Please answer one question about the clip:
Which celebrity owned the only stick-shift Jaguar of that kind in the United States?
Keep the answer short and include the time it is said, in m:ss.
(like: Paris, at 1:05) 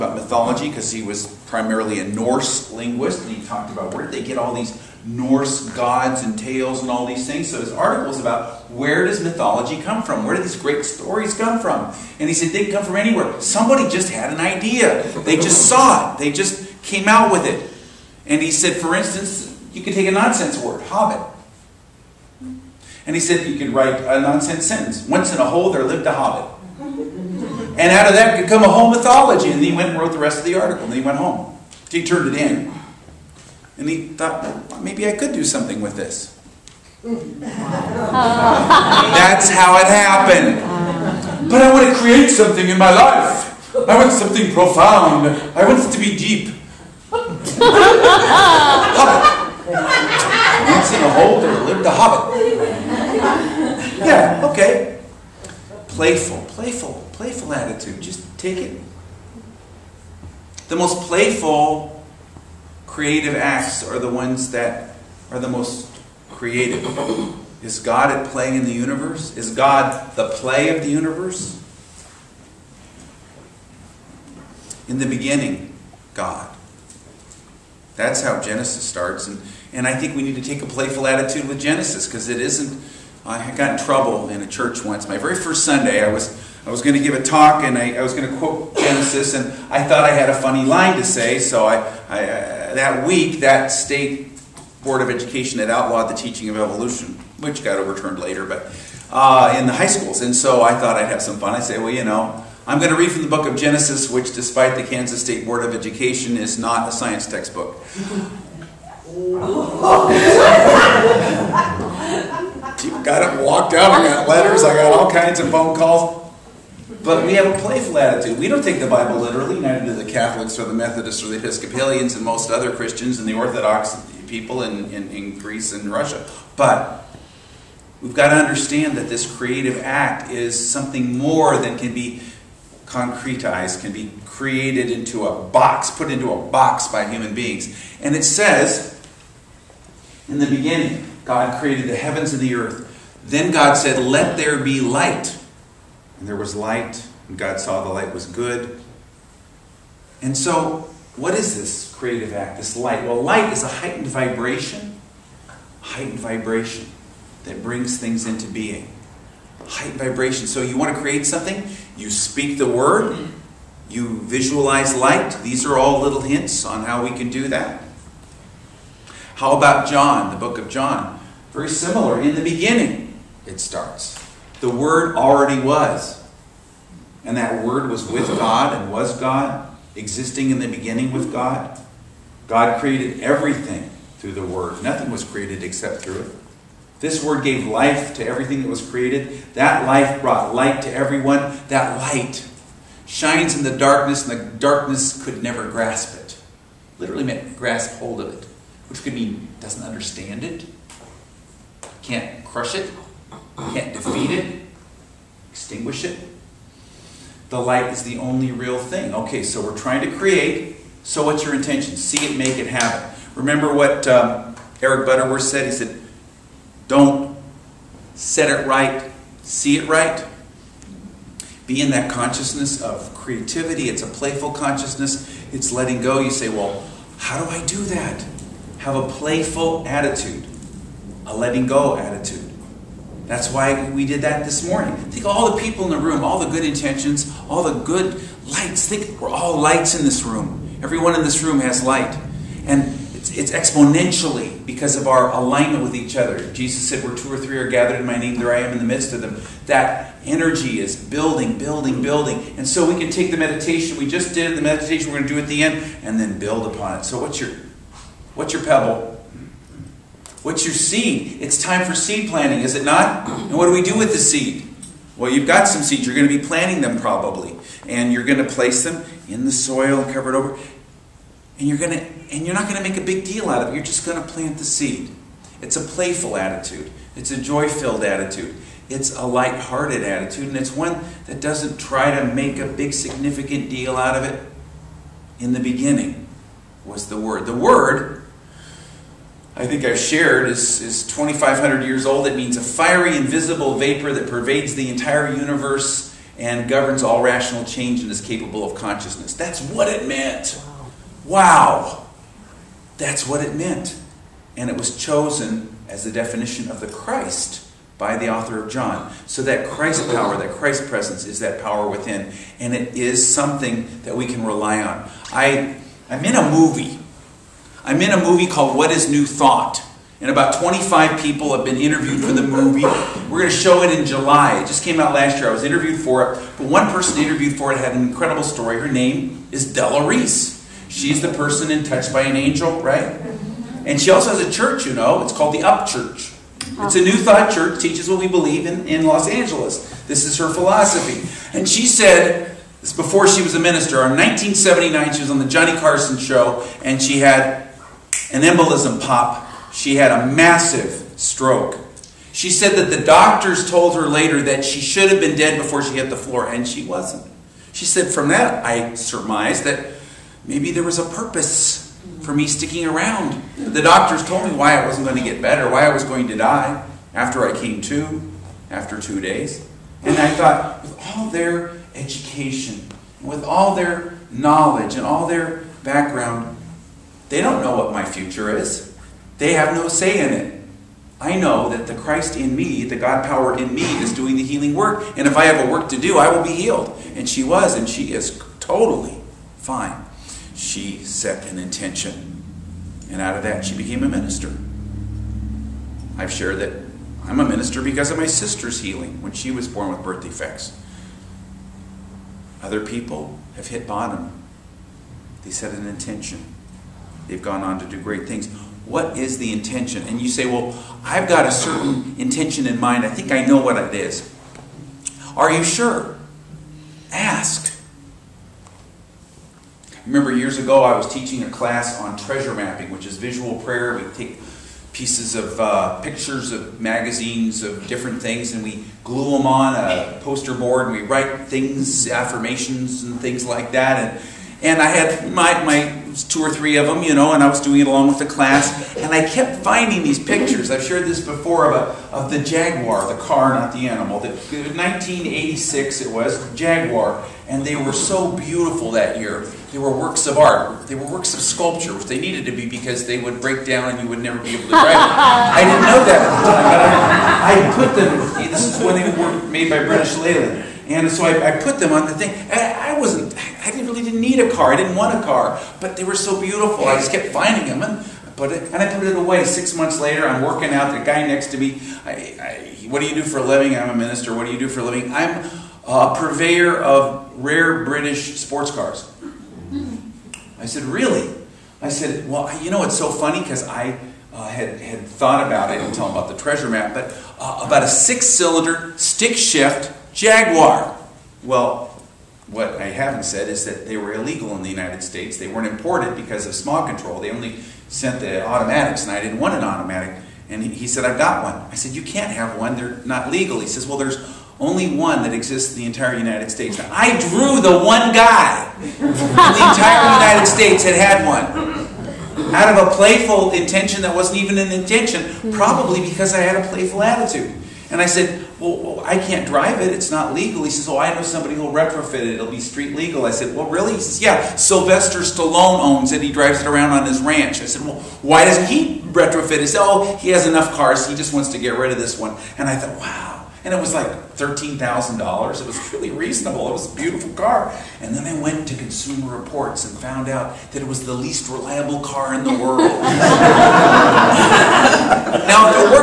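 Sylvester Stallone, at 8:44.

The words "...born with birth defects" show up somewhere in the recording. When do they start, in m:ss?
6:39.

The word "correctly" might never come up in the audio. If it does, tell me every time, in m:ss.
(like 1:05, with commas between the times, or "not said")
not said.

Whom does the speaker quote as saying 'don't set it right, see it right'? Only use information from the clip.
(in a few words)
Eric Butterworth.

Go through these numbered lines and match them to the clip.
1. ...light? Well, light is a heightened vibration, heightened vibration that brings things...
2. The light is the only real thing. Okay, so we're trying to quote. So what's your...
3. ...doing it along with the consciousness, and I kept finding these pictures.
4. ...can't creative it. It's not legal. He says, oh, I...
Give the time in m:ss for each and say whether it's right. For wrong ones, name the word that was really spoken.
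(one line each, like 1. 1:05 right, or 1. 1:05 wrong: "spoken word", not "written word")
1. 2:32 right
2. 3:27 wrong: "create", not "quote"
3. 7:17 wrong: "class", not "consciousness"
4. 8:39 wrong: "drive", not "creative".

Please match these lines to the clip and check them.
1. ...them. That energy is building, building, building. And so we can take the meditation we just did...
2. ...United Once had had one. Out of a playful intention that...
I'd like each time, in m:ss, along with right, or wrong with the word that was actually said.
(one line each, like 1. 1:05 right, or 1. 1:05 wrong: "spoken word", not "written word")
1. 4:09 right
2. 8:30 wrong: "States", not "Once".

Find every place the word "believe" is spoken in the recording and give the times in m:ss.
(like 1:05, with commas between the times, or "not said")
5:38.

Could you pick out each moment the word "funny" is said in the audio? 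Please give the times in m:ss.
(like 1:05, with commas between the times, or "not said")
1:30, 8:03.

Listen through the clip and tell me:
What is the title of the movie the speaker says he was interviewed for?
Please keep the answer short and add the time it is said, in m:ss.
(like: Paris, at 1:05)
What is New Thought, at 5:18.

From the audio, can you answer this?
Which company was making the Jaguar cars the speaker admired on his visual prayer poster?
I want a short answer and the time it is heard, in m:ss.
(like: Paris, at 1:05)
British Leyland, at 7:39.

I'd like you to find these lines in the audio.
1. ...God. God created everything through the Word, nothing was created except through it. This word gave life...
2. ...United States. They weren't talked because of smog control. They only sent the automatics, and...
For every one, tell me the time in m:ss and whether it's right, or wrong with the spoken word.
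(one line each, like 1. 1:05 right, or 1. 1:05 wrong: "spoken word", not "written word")
1. 3:01 right
2. 8:14 wrong: "imported", not "talked".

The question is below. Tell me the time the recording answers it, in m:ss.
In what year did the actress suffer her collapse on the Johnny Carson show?
5:44.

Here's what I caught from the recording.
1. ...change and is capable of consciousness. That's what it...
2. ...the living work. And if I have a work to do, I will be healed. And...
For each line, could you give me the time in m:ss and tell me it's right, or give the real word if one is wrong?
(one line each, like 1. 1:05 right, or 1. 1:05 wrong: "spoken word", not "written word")
1. 4:57 right
2. 6:24 wrong: "healing", not "living".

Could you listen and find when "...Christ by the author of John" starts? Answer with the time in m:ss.
5:06.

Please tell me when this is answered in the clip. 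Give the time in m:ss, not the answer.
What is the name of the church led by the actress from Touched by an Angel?
5:35.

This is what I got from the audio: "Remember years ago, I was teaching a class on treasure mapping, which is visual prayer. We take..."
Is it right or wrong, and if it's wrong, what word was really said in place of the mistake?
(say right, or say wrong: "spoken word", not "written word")
right.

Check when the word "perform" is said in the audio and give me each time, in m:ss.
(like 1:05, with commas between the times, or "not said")
not said.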